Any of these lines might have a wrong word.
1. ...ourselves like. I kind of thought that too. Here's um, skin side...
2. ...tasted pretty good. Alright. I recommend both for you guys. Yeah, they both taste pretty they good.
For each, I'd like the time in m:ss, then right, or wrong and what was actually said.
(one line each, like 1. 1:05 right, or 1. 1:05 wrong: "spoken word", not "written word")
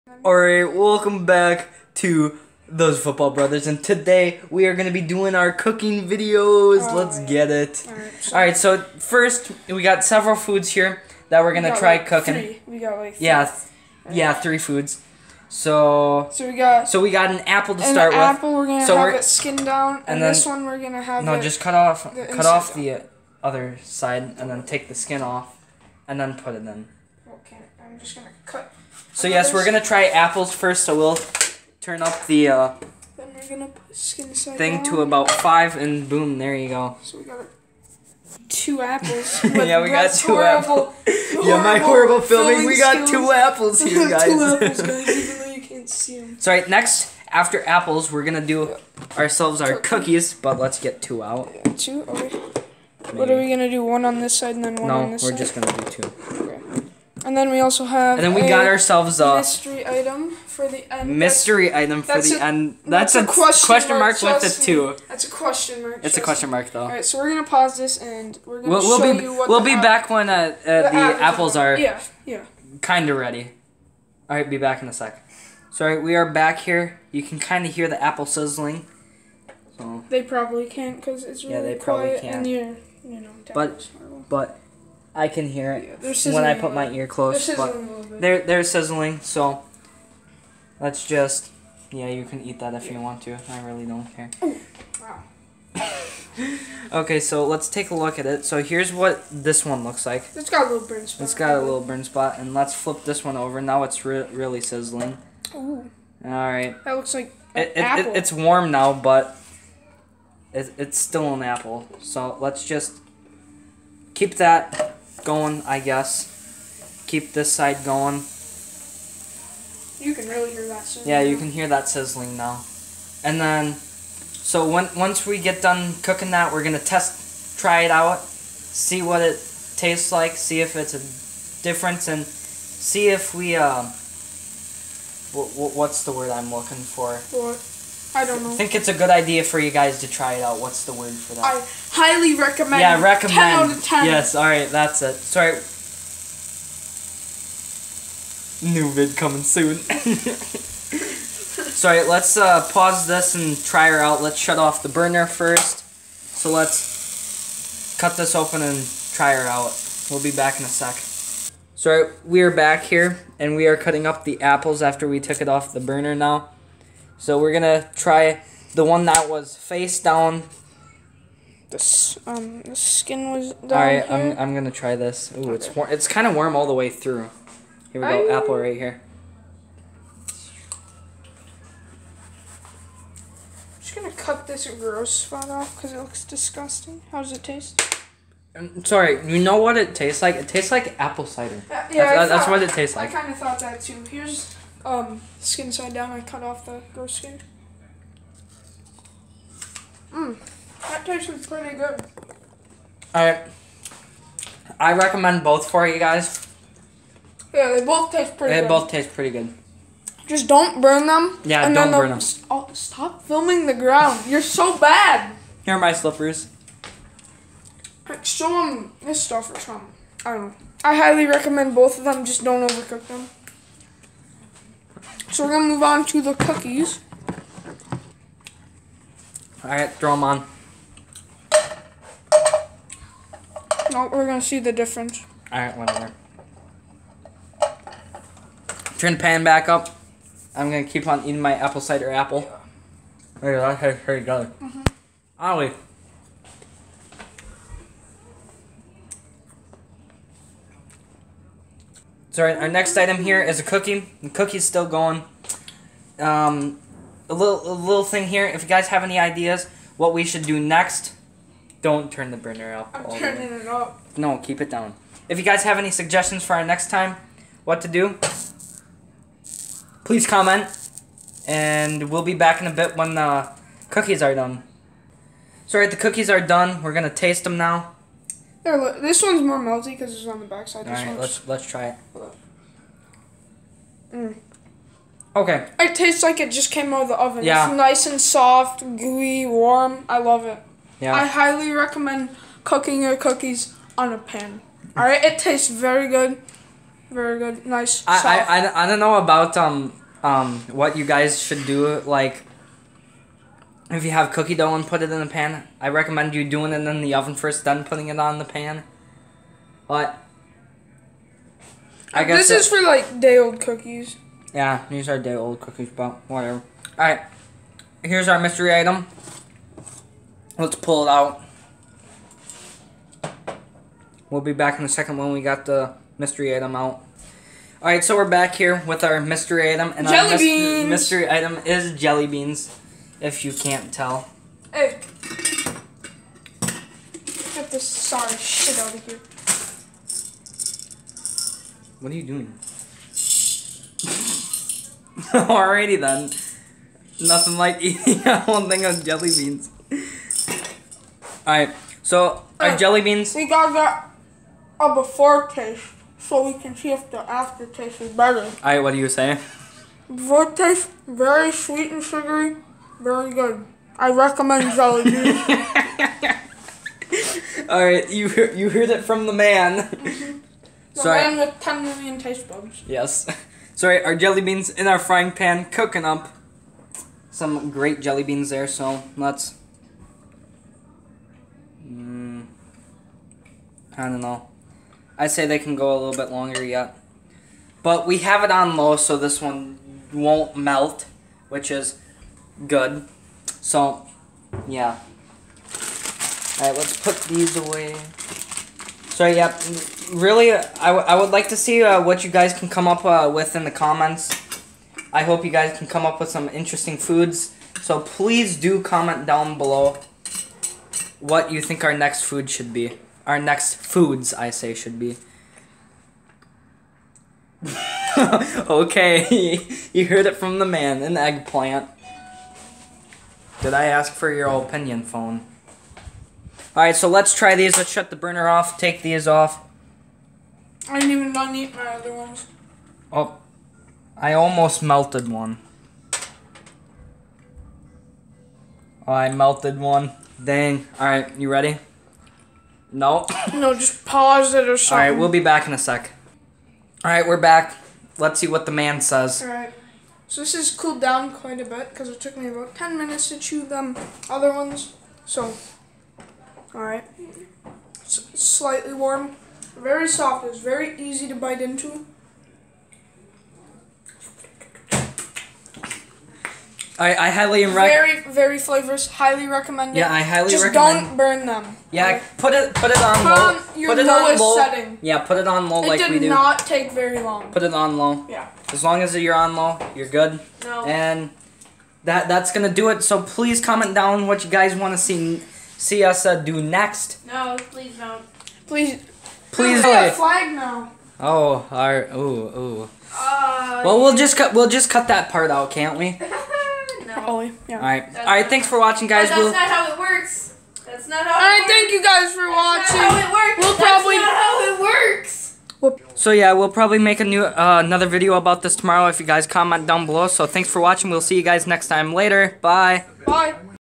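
1. 3:12 wrong: "tastes", not "ourselves"
2. 3:21 right.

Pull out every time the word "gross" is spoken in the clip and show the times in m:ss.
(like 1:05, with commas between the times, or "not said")
3:04, 3:16.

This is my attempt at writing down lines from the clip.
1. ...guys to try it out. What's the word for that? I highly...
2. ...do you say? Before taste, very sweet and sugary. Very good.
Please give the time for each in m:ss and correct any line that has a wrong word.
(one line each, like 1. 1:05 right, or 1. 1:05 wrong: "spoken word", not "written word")
1. 2:19 right
2. 5:58 right.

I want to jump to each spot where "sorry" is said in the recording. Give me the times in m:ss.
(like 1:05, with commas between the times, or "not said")
1:15, 2:25, 2:31, 2:41, 3:08, 5:37, 6:13.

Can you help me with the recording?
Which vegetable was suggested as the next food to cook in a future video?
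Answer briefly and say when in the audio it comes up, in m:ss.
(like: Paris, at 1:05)
eggplant, at 7:01.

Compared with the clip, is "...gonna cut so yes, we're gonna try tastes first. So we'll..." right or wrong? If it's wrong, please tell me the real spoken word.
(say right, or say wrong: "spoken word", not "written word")
wrong: "apples", not "tastes".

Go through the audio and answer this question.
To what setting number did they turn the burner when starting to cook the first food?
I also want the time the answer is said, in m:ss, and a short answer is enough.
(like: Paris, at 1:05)
5, at 0:34.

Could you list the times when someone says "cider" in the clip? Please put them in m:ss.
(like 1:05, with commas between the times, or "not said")
3:11, 4:01.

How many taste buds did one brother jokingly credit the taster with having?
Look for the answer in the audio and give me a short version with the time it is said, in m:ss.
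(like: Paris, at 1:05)
10 million, at 6:11.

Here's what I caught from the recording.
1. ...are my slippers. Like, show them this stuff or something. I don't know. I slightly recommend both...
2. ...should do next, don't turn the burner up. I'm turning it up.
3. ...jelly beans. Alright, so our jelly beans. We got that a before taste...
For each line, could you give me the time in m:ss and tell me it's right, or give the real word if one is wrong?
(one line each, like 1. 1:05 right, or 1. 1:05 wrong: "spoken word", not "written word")
1. 3:35 wrong: "highly", not "slightly"
2. 4:20 right
3. 5:49 right.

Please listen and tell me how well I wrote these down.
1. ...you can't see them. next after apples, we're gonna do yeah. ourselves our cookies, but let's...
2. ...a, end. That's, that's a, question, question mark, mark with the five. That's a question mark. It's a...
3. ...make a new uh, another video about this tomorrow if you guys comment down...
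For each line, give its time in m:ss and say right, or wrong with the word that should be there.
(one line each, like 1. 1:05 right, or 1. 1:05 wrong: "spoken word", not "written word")
1. 0:45 right
2. 1:02 wrong: "two", not "five"
3. 8:26 right.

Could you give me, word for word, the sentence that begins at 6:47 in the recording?
So please do comment down below what you think our next food should be.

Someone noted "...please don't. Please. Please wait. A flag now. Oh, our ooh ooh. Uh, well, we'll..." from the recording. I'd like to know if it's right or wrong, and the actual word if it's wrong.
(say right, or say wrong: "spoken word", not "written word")
right.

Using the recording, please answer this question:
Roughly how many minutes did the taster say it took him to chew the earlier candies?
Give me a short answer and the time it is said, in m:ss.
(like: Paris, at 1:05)
10 minutes, at 7:32.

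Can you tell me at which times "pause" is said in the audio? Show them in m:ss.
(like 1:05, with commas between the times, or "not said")
1:07, 2:32, 7:24.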